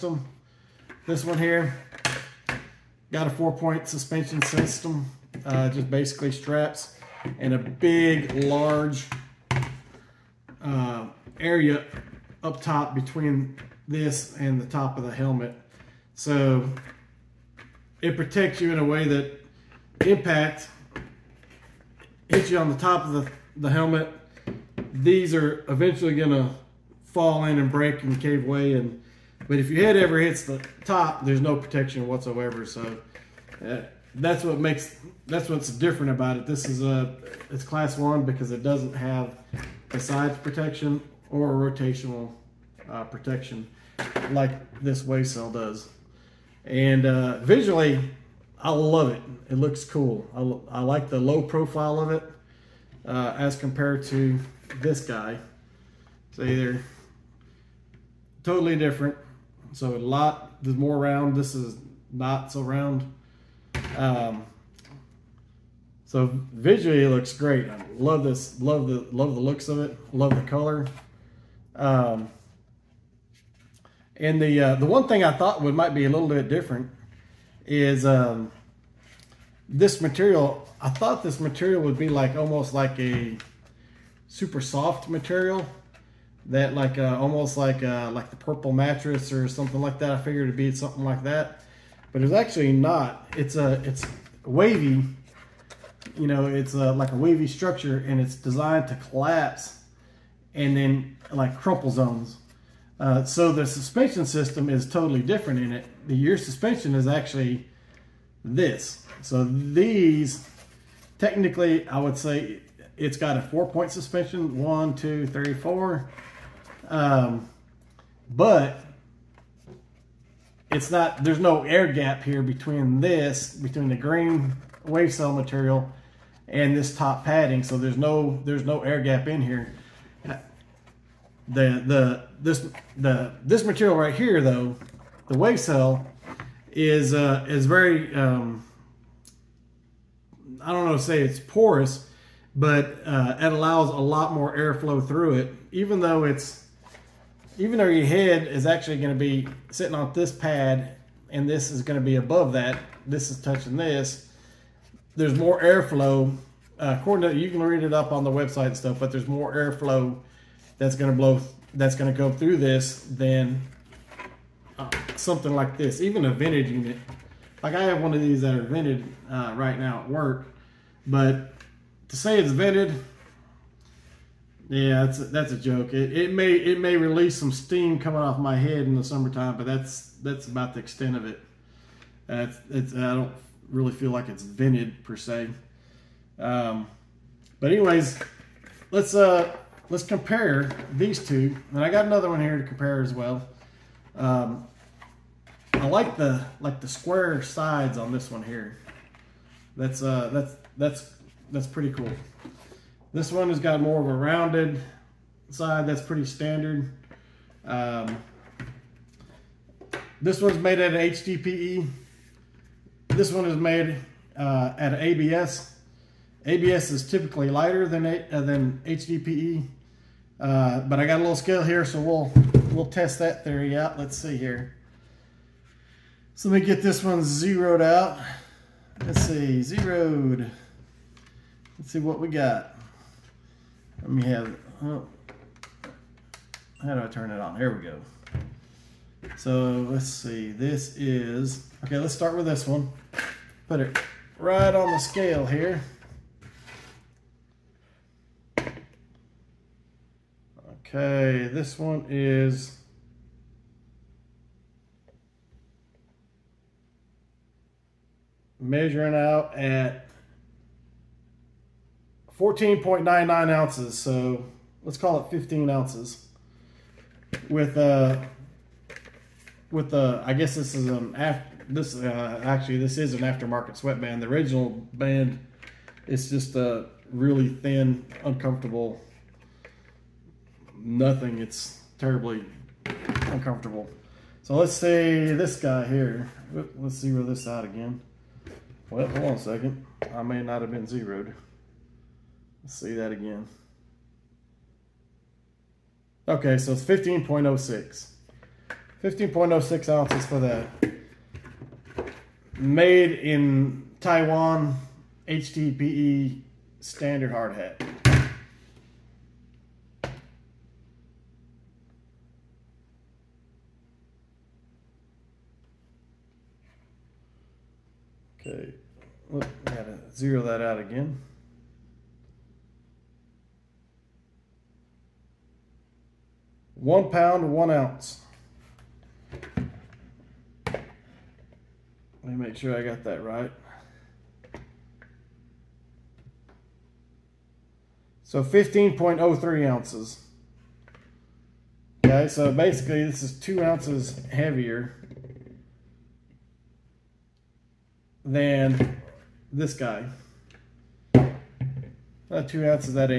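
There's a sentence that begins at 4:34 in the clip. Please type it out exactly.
The original band is just a really thin, uncomfortable nothing.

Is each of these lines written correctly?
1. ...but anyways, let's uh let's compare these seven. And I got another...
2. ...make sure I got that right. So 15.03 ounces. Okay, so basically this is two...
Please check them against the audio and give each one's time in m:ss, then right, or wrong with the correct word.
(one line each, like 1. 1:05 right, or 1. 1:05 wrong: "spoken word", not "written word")
1. 3:07 wrong: "two", not "seven"
2. 5:32 right.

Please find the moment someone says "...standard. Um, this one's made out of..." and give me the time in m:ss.
3:26.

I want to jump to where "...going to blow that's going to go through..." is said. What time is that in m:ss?
2:40.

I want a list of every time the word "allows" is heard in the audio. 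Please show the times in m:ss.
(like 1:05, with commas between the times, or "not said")
2:23.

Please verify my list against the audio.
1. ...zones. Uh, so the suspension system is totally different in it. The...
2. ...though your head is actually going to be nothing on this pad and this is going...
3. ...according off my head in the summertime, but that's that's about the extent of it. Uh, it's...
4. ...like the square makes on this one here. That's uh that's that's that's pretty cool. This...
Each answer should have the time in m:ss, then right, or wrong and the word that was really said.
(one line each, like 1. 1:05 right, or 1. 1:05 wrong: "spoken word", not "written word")
1. 1:41 right
2. 2:27 wrong: "sitting", not "nothing"
3. 2:57 wrong: "coming", not "according"
4. 3:16 wrong: "sides", not "makes".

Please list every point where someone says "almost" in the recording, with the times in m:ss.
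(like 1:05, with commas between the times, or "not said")
1:22, 1:27.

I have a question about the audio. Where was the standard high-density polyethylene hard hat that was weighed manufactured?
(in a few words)
Taiwan.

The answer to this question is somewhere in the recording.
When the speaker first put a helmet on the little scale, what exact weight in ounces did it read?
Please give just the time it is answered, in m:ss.
4:22.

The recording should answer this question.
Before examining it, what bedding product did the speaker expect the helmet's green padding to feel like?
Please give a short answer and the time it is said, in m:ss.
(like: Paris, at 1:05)
the purple mattress, at 1:28.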